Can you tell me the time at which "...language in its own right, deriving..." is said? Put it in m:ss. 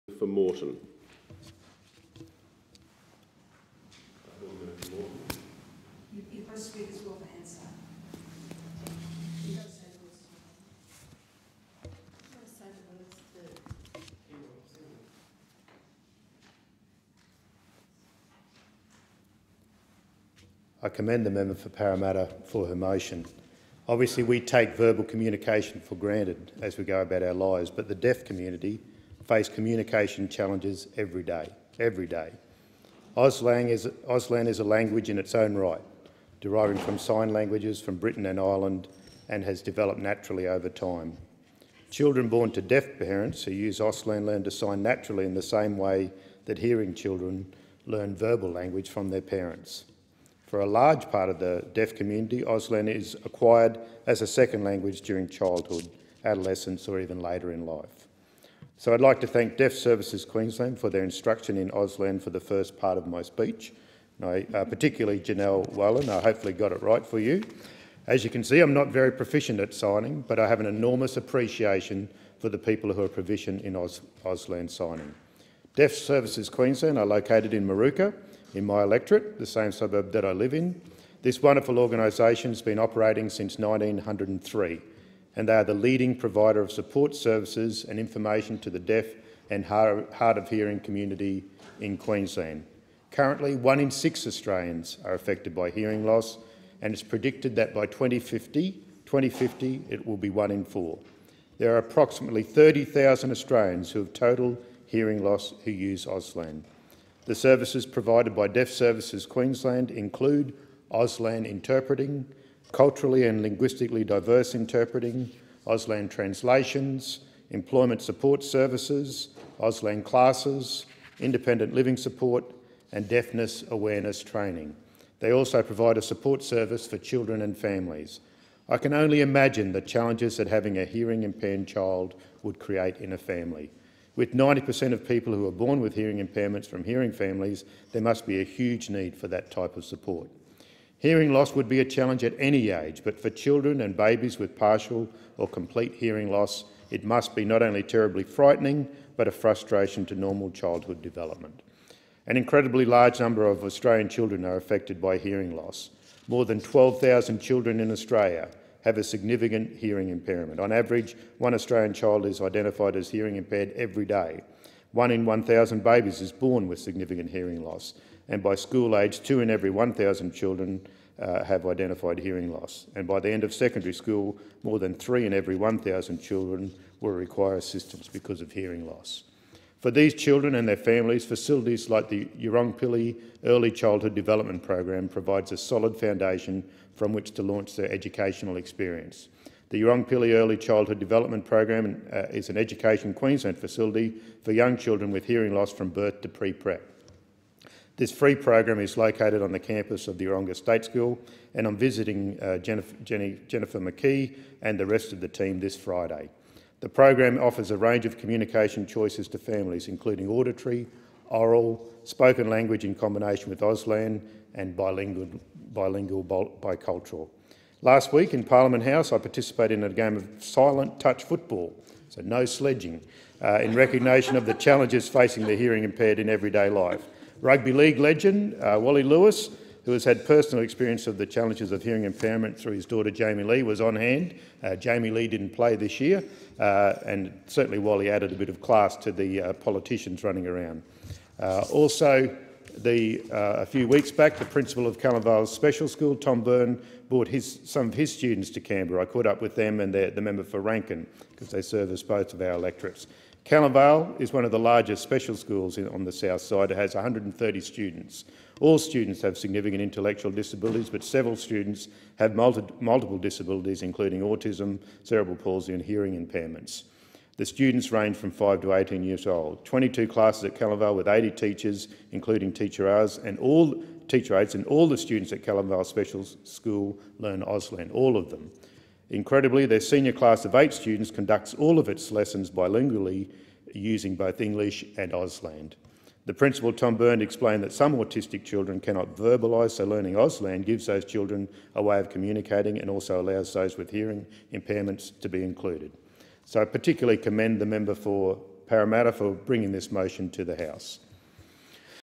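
0:34.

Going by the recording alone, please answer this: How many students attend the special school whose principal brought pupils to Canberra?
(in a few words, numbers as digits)
130.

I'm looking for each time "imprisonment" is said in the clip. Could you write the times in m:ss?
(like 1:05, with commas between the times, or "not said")
not said.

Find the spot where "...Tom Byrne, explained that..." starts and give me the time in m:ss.
4:46.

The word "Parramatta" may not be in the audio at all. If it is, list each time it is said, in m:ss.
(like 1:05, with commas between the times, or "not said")
0:21, 4:58.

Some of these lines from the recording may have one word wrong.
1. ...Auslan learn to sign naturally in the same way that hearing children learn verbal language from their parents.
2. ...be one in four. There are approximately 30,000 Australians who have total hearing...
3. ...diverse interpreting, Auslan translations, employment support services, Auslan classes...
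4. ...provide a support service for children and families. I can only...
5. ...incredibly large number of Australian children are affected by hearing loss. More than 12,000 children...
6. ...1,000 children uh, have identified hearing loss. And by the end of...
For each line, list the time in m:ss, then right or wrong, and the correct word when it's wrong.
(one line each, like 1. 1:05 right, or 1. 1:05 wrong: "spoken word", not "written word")
1. 0:43 right
2. 1:40 right
3. 1:54 right
4. 2:05 right
5. 2:32 right
6. 2:49 right.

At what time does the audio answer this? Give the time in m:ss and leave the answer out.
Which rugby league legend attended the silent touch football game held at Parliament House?
3:48.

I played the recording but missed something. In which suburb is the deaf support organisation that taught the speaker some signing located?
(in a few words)
Moorooka.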